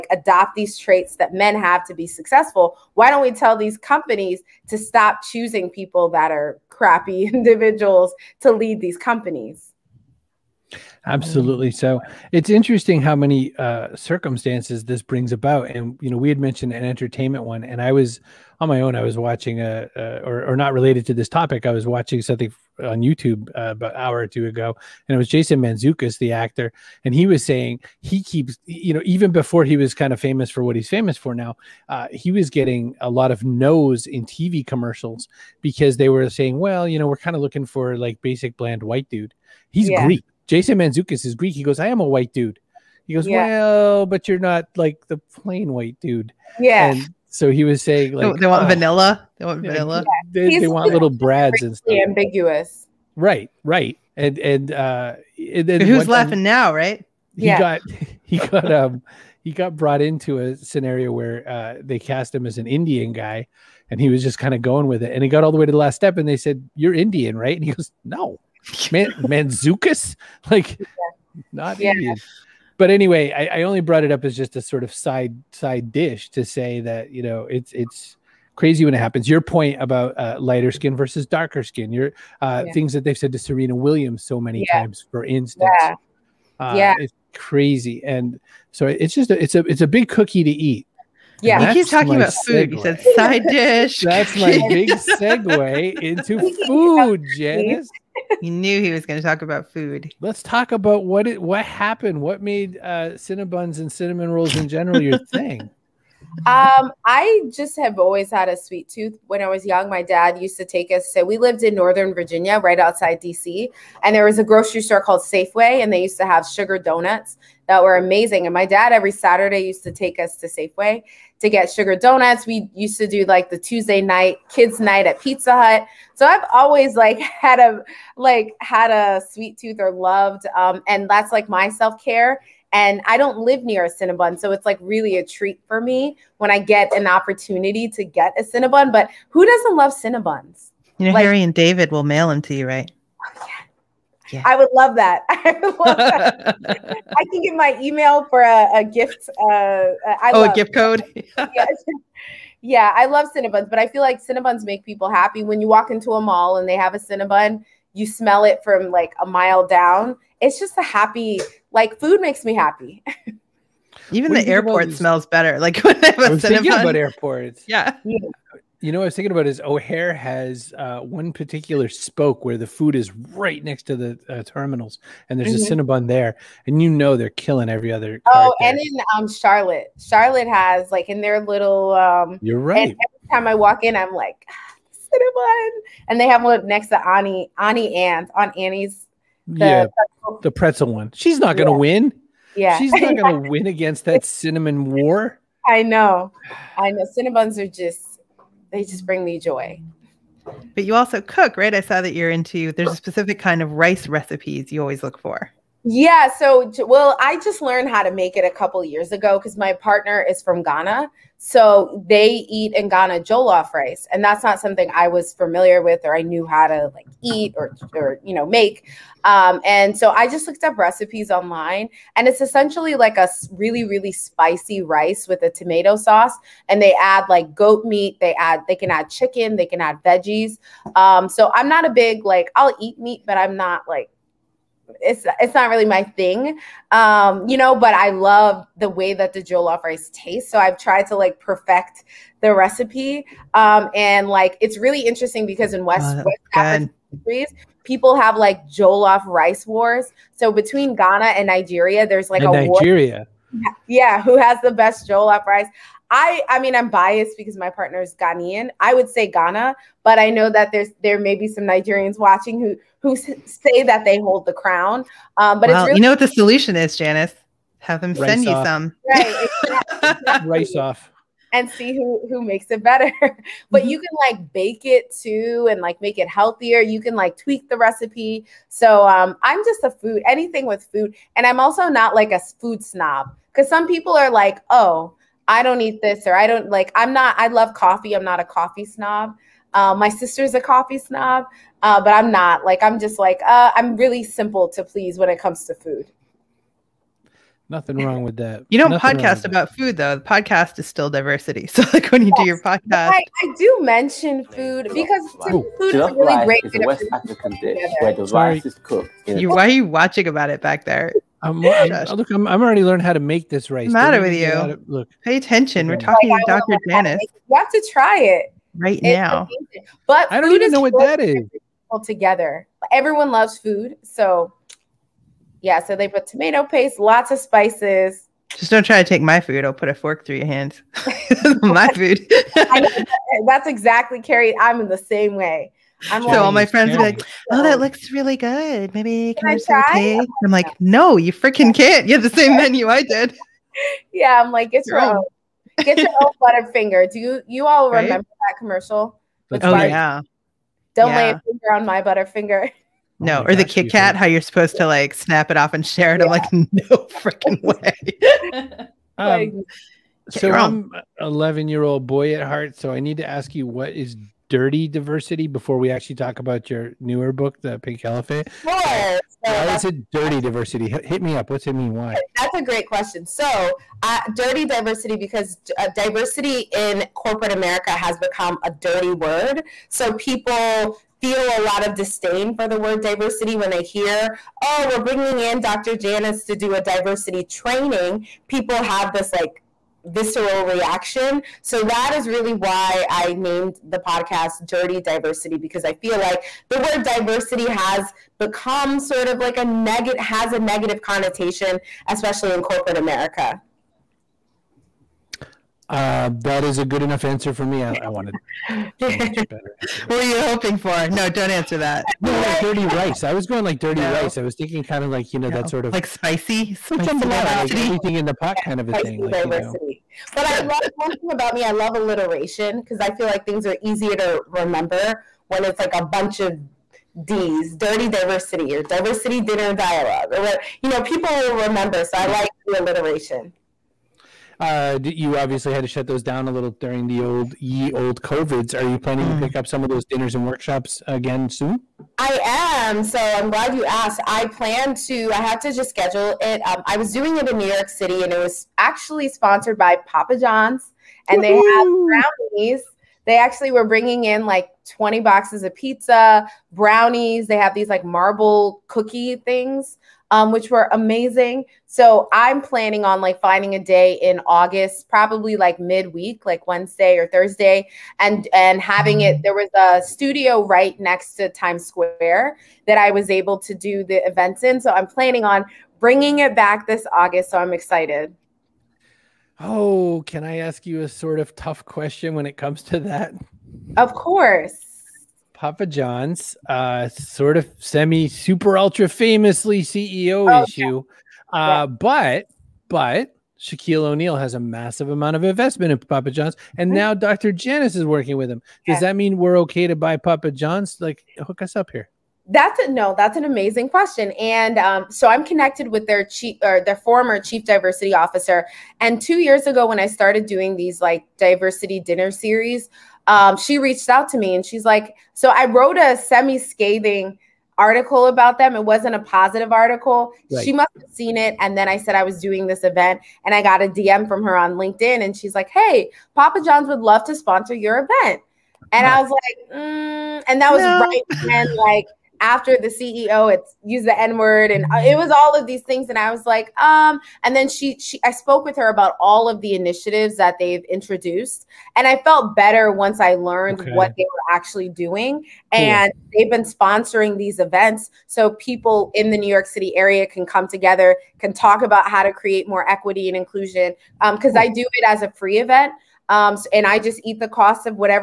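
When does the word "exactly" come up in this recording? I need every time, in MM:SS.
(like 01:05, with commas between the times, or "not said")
04:30, 05:33.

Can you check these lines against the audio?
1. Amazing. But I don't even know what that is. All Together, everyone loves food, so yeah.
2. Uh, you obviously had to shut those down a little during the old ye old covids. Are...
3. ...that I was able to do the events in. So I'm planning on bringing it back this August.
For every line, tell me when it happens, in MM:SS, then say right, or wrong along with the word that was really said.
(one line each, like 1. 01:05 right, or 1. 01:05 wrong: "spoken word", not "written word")
1. 05:19 right
2. 07:14 right
3. 07:52 right.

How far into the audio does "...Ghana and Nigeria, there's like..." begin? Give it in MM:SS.
04:10.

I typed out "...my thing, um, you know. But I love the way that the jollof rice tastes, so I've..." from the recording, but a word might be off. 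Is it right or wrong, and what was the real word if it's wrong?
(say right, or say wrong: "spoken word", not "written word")
right.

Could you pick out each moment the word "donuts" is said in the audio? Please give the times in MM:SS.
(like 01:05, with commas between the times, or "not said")
01:56, 02:01.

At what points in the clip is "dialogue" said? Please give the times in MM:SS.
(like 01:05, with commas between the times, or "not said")
07:09.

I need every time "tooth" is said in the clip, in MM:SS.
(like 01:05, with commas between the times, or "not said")
01:48, 02:09.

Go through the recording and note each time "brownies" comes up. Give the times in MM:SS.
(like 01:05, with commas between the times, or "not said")
07:32, 07:36.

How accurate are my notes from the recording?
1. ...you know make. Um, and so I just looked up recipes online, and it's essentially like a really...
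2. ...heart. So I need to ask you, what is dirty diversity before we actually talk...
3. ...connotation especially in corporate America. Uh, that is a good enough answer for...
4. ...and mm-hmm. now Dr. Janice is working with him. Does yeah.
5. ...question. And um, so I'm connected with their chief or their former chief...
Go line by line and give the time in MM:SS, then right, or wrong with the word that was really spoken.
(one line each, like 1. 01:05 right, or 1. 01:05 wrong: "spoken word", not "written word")
1. 03:38 right
2. 06:02 right
3. 06:41 right
4. 08:16 right
5. 08:23 right.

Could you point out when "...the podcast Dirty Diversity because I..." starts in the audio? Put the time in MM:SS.
06:33.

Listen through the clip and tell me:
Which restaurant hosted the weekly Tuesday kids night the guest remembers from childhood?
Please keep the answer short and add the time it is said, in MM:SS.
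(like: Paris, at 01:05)
Pizza Hut, at 02:05.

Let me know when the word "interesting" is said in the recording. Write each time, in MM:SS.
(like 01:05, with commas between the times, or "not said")
00:12, 04:05.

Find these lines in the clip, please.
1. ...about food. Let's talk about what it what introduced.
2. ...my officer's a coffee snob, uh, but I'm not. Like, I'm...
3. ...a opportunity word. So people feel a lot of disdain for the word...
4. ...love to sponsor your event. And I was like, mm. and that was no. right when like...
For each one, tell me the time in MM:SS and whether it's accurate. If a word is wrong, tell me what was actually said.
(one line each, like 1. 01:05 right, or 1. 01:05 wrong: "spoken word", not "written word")
1. 01:39 wrong: "happened", not "introduced"
2. 04:49 wrong: "sister", not "officer"
3. 06:18 wrong: "dirty", not "opportunity"
4. 08:46 right.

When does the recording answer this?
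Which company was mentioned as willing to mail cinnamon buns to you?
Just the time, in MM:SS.
02:21.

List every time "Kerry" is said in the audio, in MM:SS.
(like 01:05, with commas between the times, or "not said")
05:34.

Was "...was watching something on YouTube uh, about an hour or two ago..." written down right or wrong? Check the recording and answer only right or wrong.
right.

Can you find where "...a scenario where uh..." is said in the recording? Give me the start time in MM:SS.
01:00.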